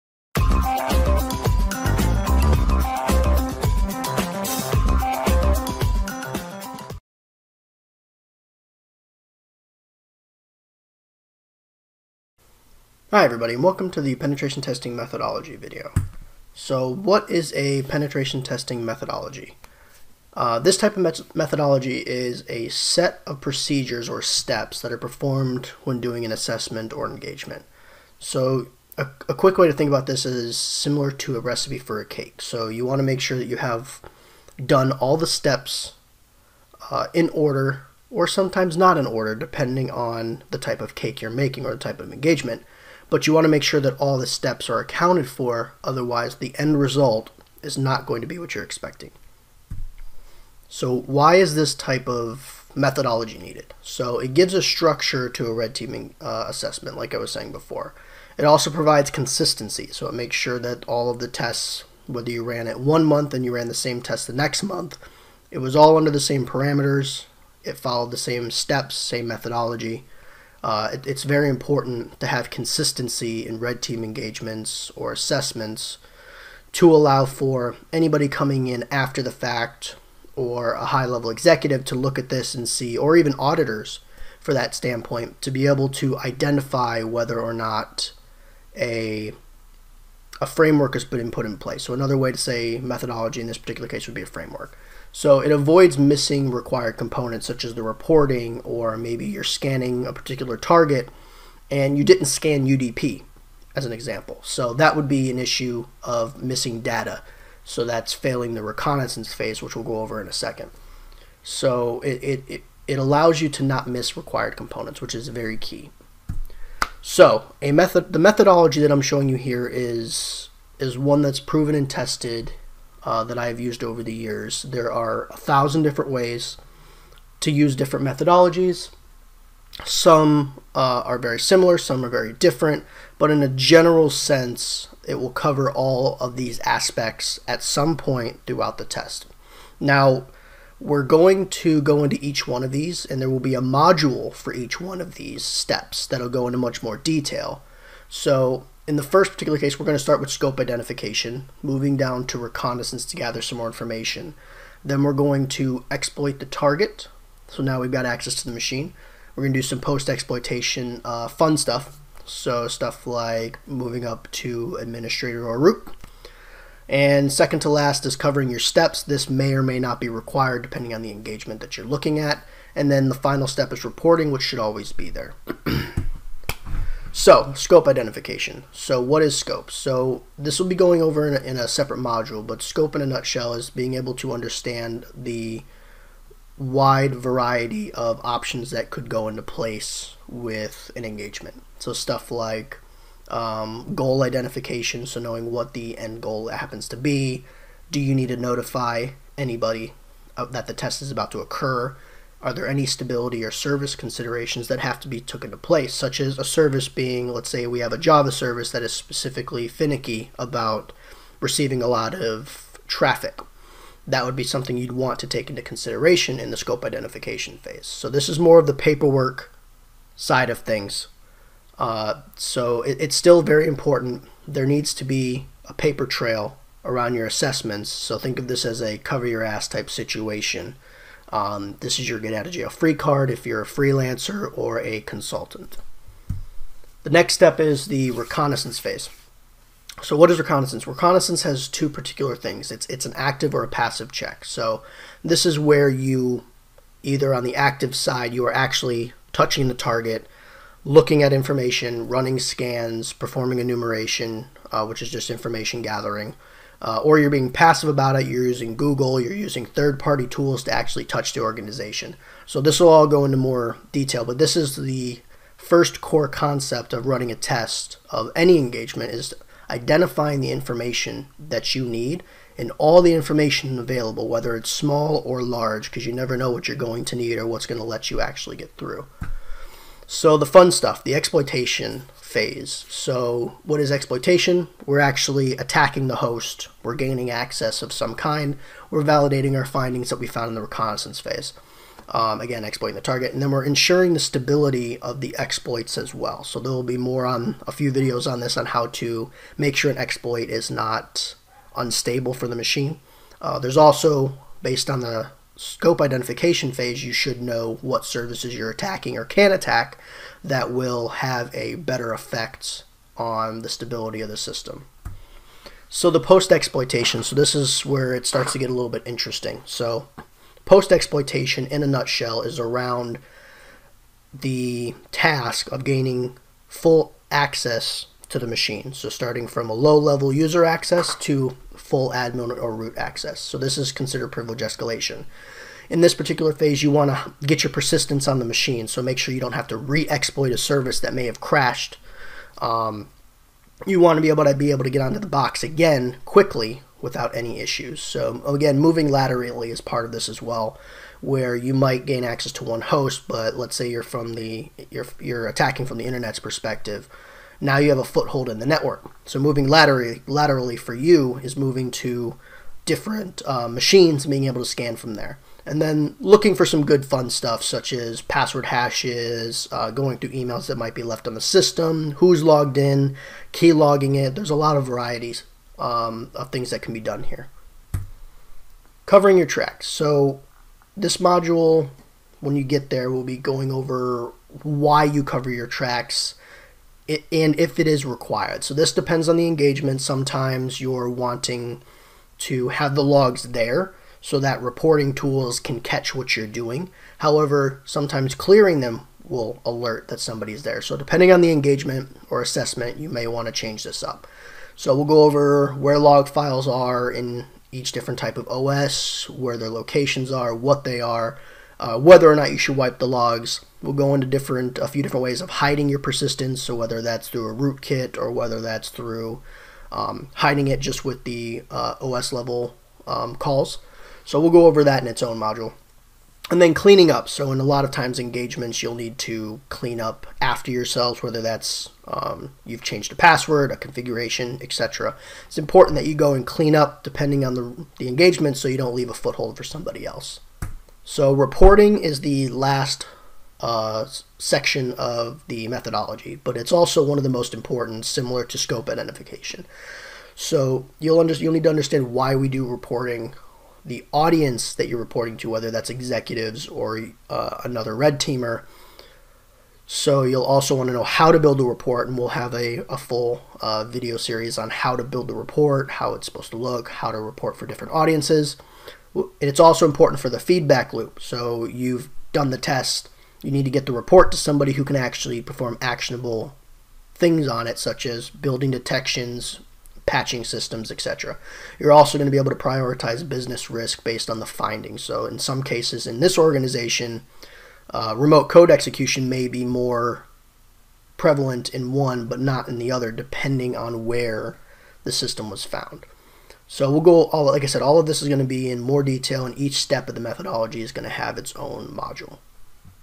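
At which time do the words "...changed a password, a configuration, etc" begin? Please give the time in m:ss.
7:12.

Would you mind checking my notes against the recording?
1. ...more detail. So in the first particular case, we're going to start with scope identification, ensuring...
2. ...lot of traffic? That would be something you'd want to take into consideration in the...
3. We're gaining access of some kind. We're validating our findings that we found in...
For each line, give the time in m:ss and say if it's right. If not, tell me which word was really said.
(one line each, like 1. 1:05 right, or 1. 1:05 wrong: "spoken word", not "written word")
1. 2:26 wrong: "moving", not "ensuring"
2. 3:31 right
3. 4:46 right.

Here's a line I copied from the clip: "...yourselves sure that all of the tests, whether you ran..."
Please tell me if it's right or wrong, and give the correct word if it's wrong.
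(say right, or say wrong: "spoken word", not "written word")
wrong: "makes", not "yourselves".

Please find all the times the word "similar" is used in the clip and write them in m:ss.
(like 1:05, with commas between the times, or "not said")
0:30, 2:11, 7:28.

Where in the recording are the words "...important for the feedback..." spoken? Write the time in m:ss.
7:49.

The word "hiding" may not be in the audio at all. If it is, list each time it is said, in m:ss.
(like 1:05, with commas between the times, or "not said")
6:55, 7:00.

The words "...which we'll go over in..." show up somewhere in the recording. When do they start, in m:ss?
1:49.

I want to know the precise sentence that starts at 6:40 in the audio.
So depending on the engagement or assessment, you may want to change this up.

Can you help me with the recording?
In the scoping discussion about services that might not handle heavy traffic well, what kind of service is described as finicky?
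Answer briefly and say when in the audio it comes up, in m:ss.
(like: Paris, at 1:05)
Java service, at 3:27.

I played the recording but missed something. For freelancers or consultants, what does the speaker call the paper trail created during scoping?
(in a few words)
get out of jail free card.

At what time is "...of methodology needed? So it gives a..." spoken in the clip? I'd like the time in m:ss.
0:52.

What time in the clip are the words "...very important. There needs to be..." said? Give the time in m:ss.
3:43.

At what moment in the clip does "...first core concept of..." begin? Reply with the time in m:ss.
4:25.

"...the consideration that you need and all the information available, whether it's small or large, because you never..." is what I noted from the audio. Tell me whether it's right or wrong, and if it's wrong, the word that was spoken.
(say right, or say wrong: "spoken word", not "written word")
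wrong: "information", not "consideration".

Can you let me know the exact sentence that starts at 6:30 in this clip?
Sometimes you're wanting to have the logs there so that reporting tools can catch what you're doing.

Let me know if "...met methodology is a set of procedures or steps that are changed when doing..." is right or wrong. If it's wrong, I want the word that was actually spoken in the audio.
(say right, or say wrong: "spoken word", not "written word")
wrong: "performed", not "changed".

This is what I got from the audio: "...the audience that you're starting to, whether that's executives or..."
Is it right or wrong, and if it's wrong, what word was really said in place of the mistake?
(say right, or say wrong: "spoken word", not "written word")
wrong: "reporting", not "starting".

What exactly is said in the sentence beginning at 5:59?
So moving laterally, laterally for you is moving to different uh, machines and being able to scan from there.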